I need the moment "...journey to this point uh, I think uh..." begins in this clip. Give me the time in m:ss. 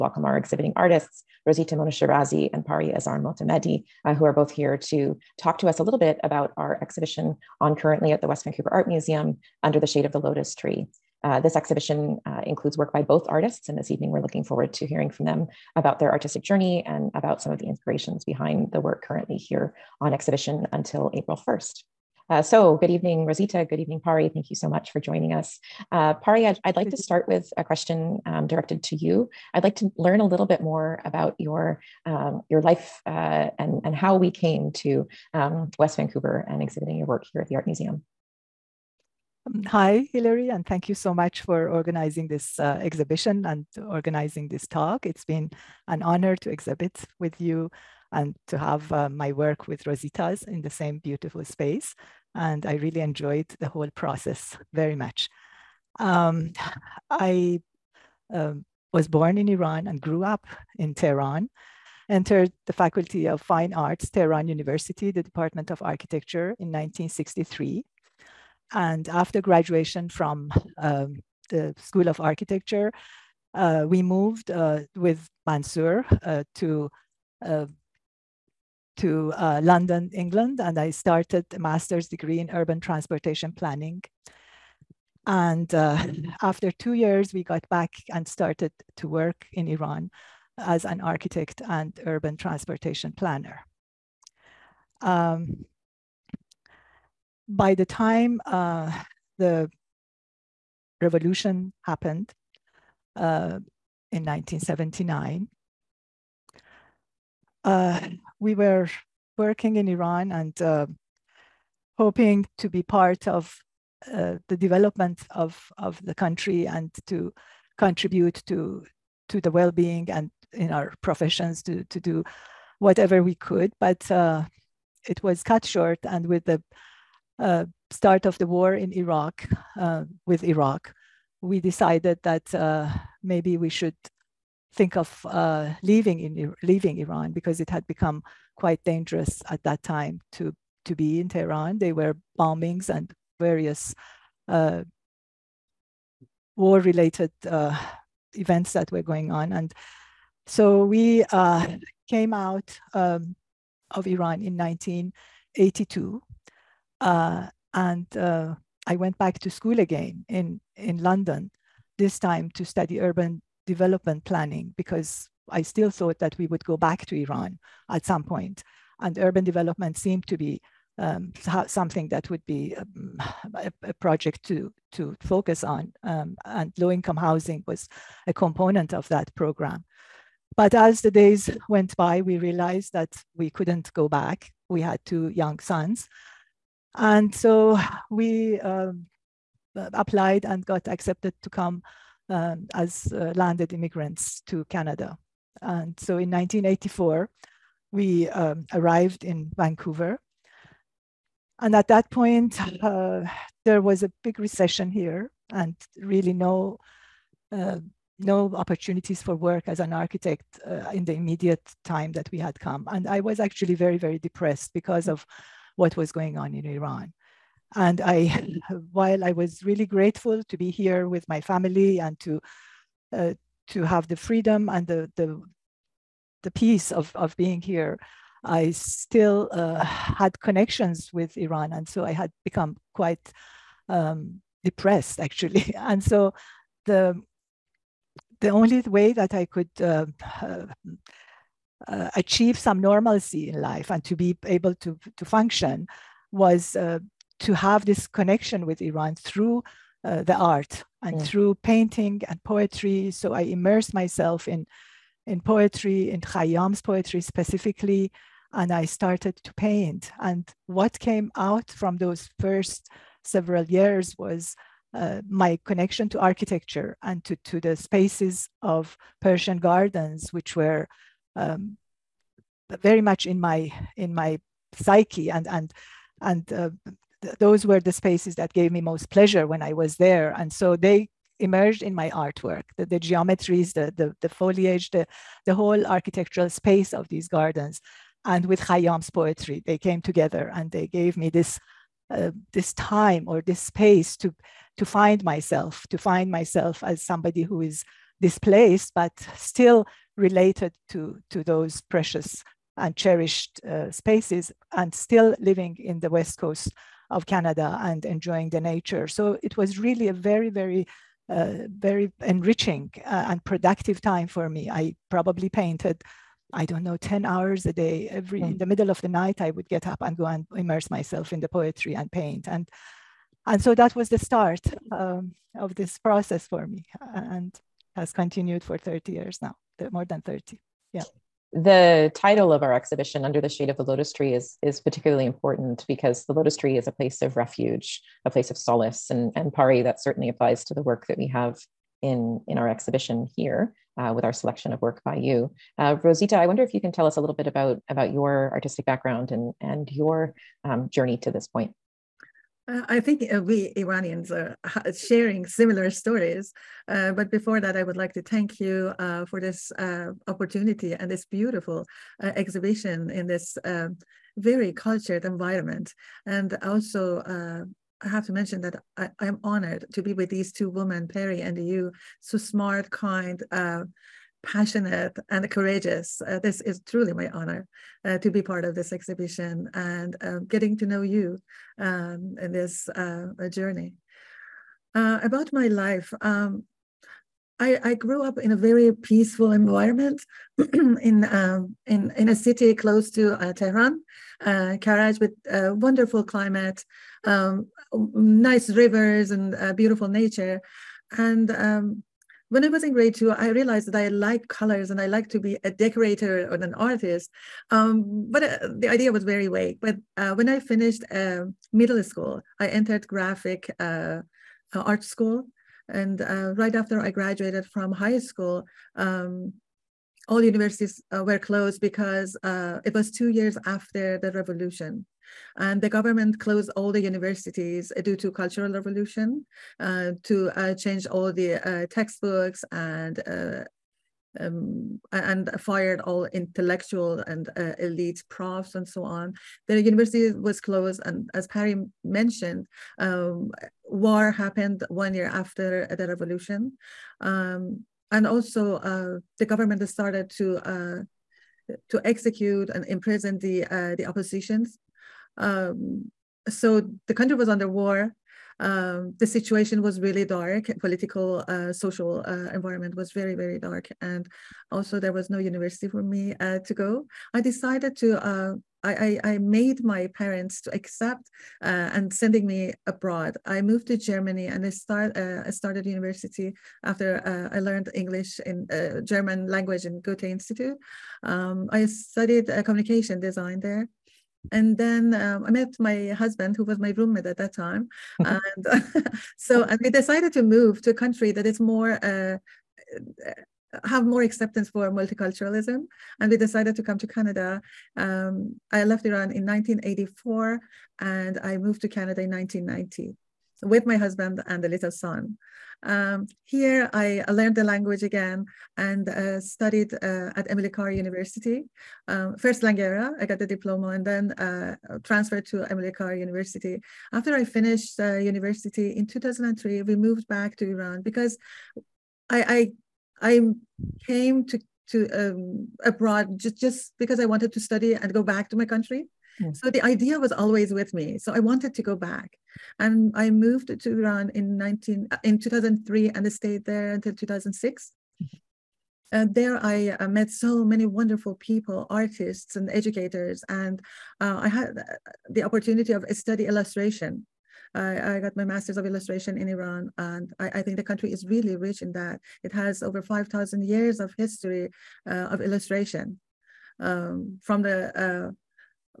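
5:50.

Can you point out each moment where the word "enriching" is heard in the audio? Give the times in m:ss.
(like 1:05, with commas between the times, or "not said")
5:12.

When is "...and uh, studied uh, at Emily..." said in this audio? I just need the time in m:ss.
8:28.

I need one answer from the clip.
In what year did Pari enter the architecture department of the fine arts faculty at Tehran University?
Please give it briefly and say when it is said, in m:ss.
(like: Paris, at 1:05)
1963, at 1:06.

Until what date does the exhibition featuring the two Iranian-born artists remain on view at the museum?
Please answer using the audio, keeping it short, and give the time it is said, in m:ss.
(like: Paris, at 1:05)
April 1st, at 0:21.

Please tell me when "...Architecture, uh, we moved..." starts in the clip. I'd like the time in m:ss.
1:12.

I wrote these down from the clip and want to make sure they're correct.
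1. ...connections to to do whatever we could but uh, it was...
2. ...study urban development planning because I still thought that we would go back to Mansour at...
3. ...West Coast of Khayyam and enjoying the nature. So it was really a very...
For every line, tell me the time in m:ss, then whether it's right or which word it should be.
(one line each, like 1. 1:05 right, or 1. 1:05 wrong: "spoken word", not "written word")
1. 2:01 wrong: "professions", not "connections"
2. 2:42 wrong: "Iran", not "Mansour"
3. 5:06 wrong: "Canada", not "Khayyam".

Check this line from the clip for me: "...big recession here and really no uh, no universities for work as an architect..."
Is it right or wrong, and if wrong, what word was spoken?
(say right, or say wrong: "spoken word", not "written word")
wrong: "opportunities", not "universities".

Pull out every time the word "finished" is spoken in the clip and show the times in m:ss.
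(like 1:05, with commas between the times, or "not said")
6:50, 8:37.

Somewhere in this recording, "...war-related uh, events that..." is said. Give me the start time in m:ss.
2:26.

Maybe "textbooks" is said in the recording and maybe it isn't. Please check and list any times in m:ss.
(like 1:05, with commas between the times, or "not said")
7:11.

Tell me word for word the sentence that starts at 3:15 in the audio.
And so in 1984, we um, arrived in Vancouver.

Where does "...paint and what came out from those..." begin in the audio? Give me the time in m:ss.
4:19.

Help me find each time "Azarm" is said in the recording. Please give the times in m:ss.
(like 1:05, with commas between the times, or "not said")
0:02.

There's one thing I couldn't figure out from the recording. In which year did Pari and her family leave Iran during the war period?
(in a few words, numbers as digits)
1982.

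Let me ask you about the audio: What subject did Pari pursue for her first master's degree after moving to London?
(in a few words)
urban transportation planning.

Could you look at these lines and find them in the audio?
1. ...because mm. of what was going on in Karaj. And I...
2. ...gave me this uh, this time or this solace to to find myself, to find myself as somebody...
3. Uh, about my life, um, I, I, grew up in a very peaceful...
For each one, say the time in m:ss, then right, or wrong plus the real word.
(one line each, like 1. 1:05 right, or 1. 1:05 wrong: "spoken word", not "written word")
1. 3:34 wrong: "Iran", not "Karaj"
2. 4:50 wrong: "space", not "solace"
3. 6:24 right.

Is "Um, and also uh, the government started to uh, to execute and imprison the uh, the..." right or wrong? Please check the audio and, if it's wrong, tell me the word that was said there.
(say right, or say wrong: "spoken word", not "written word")
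right.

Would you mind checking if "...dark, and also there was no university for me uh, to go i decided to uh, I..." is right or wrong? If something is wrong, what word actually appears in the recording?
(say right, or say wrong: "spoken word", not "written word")
right.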